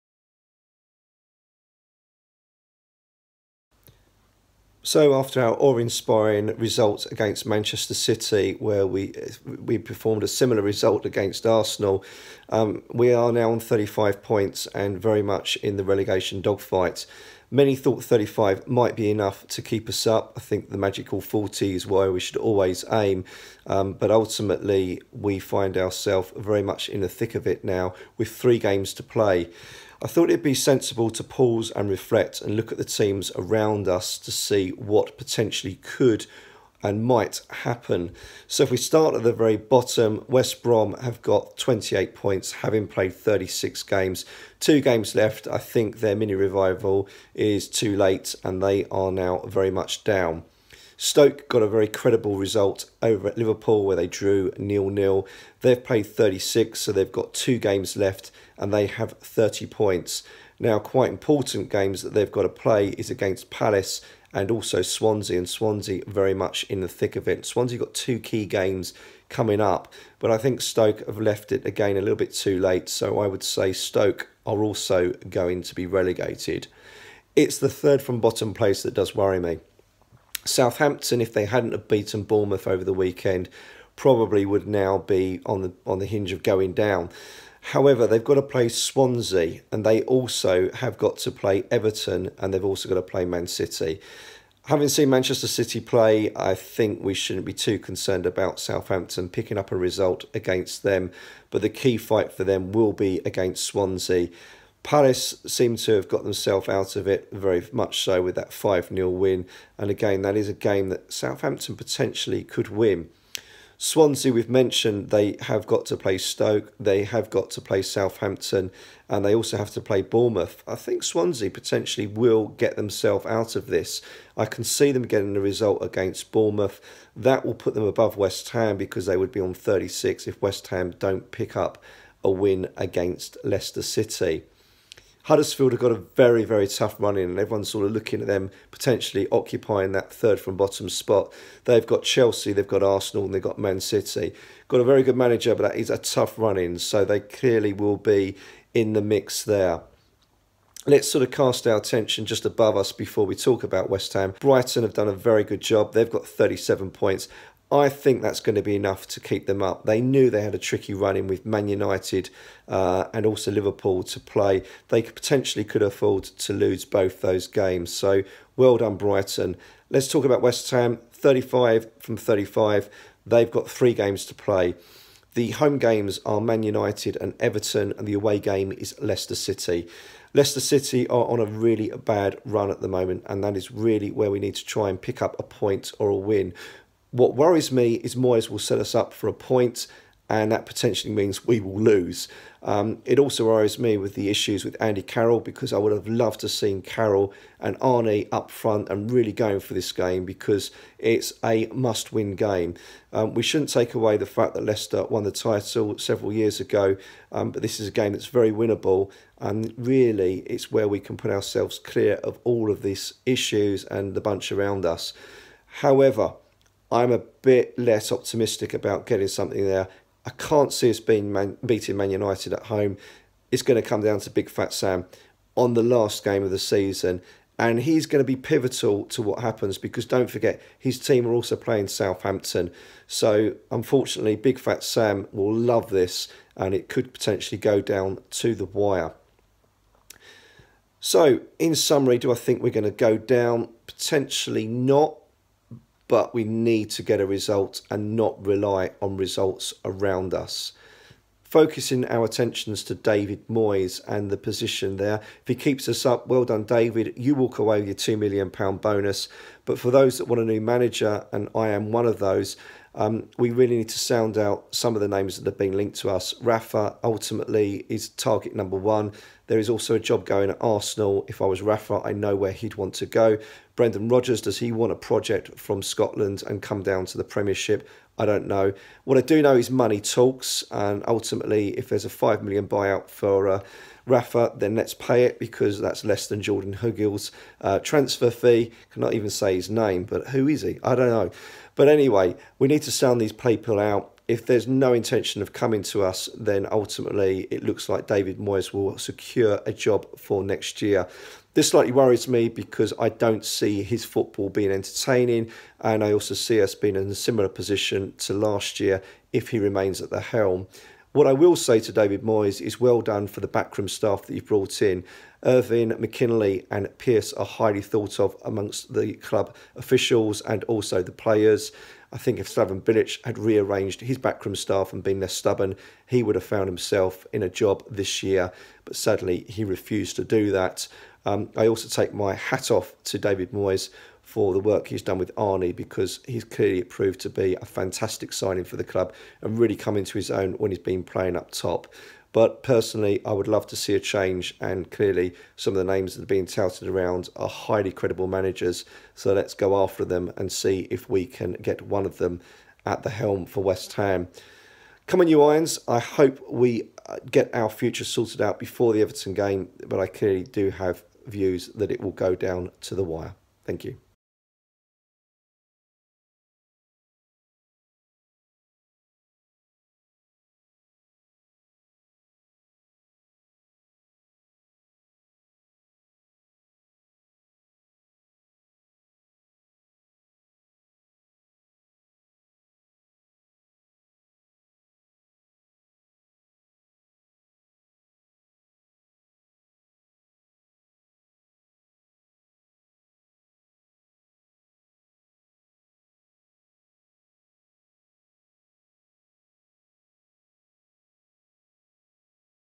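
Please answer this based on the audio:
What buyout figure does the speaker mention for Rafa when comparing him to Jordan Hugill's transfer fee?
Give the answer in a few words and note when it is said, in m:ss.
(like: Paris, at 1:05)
£5 million, at 4:42.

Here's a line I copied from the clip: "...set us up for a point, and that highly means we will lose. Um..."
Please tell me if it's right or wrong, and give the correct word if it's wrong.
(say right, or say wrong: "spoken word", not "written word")
wrong: "potentially", not "highly".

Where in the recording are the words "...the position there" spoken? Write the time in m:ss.
4:14.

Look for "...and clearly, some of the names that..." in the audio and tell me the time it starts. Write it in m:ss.
5:44.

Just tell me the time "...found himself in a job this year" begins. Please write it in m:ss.
5:26.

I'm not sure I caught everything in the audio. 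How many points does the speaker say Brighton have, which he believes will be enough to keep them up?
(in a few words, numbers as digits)
37.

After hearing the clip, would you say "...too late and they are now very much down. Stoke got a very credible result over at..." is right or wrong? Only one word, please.
right.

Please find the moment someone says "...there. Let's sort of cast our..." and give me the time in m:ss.
2:29.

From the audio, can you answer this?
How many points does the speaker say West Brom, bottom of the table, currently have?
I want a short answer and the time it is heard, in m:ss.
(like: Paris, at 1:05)
28, at 0:41.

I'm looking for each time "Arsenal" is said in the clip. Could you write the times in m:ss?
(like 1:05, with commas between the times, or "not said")
0:11, 2:22, 4:30.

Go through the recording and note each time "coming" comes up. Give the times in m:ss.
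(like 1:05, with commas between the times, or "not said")
1:09, 4:55.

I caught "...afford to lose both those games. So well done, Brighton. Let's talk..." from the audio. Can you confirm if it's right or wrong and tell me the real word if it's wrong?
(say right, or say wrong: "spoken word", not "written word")
right.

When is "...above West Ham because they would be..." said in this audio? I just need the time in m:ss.
2:07.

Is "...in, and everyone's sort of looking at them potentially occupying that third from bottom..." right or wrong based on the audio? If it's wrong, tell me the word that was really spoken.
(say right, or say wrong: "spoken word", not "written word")
right.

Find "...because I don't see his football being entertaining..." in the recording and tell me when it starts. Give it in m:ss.
5:02.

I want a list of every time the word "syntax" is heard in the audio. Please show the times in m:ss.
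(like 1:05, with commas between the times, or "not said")
not said.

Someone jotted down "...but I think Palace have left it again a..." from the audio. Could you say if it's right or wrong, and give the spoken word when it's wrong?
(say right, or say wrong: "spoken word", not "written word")
wrong: "Stoke", not "Palace".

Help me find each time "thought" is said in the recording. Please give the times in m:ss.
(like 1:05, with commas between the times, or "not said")
0:17, 0:30, 5:17.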